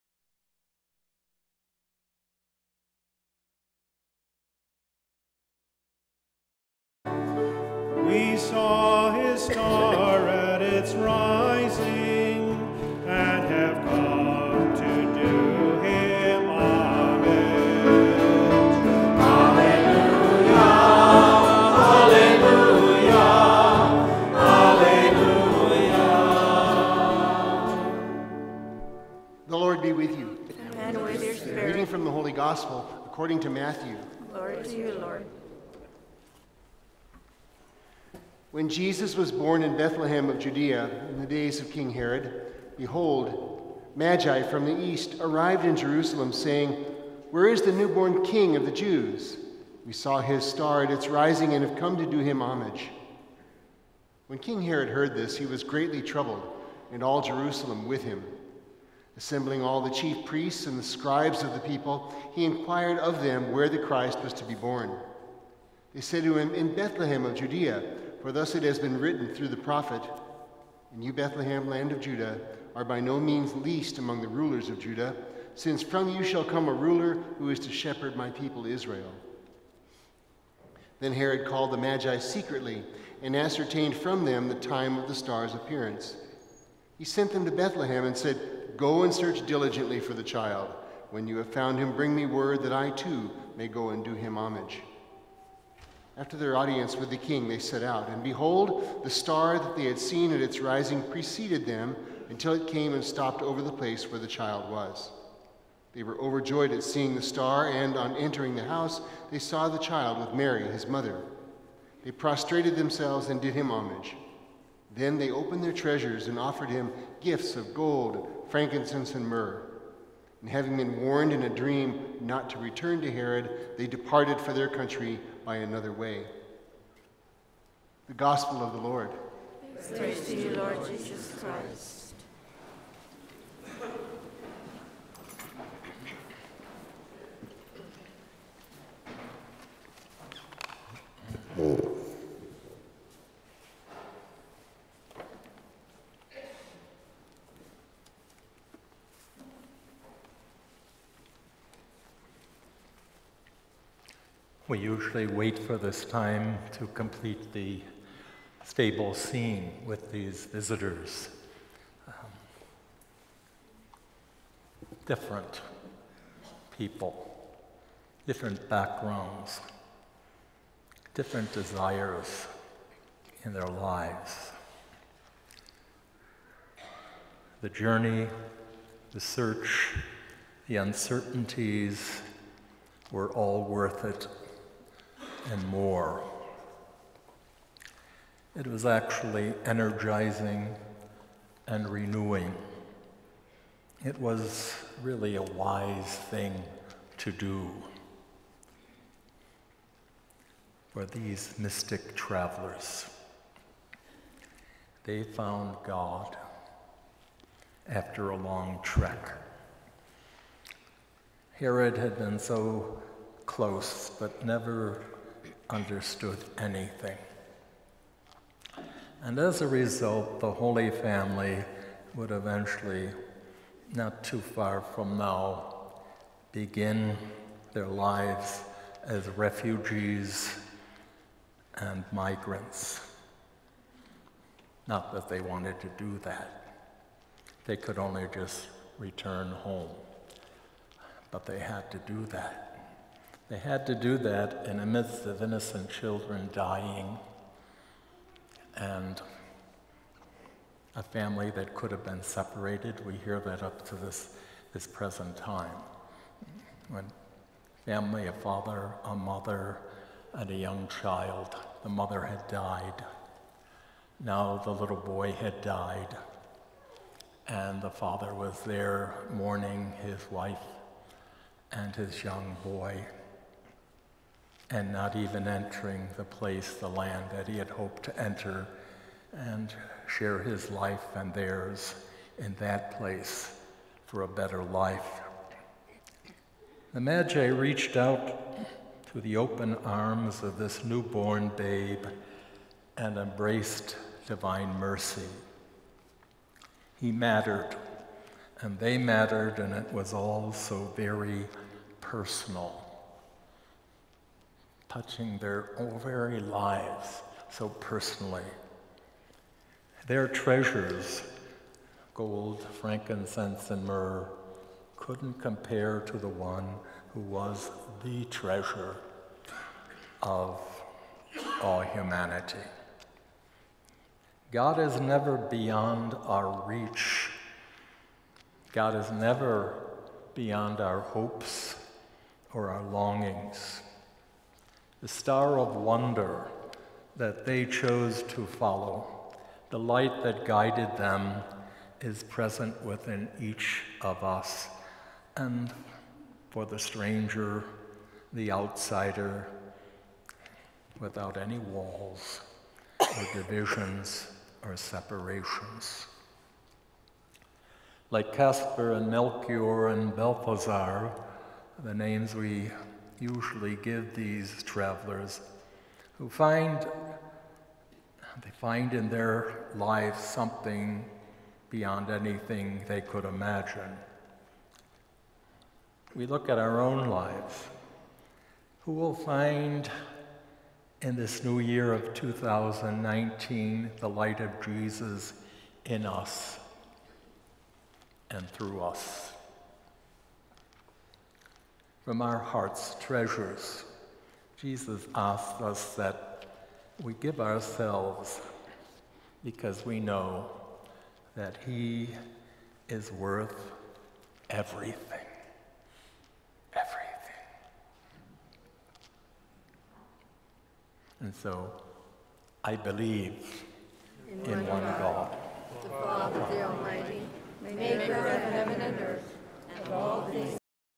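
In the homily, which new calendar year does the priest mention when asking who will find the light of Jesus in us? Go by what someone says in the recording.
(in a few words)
2019.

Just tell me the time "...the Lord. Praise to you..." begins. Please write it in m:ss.
2:08.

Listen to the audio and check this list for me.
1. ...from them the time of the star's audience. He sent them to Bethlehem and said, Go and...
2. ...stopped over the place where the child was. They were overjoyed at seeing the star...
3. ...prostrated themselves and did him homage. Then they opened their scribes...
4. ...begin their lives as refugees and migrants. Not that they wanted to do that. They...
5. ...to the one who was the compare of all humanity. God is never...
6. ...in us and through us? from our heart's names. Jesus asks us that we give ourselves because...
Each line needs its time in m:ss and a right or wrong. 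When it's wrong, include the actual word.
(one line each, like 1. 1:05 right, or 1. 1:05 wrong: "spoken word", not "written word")
1. 1:23 wrong: "appearance", not "audience"
2. 1:43 right
3. 1:52 wrong: "treasures", not "scribes"
4. 3:46 right
5. 5:16 wrong: "treasure", not "compare"
6. 6:25 wrong: "treasures", not "names".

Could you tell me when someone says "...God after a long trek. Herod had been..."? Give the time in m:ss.
3:25.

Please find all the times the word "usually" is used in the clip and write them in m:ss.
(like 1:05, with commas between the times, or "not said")
2:34, 6:03.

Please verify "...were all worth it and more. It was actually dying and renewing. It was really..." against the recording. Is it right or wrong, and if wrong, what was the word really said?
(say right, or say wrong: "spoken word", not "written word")
wrong: "energizing", not "dying".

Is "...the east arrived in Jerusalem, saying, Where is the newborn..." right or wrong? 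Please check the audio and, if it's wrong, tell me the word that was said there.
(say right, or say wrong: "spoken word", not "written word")
right.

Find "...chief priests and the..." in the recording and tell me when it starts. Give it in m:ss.
0:59.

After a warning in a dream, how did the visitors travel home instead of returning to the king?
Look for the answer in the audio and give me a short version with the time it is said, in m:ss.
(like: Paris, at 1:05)
By another way, at 2:05.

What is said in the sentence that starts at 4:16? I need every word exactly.
When family, a father, a mother, and a young child, the mother had died.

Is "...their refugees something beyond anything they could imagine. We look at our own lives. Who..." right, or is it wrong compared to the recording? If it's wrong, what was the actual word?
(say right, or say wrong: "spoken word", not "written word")
wrong: "lives", not "refugees".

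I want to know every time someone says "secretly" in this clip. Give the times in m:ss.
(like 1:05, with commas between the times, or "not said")
1:22.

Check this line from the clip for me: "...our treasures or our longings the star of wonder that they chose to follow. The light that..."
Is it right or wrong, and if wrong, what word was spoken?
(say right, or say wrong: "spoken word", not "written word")
wrong: "hopes", not "treasures".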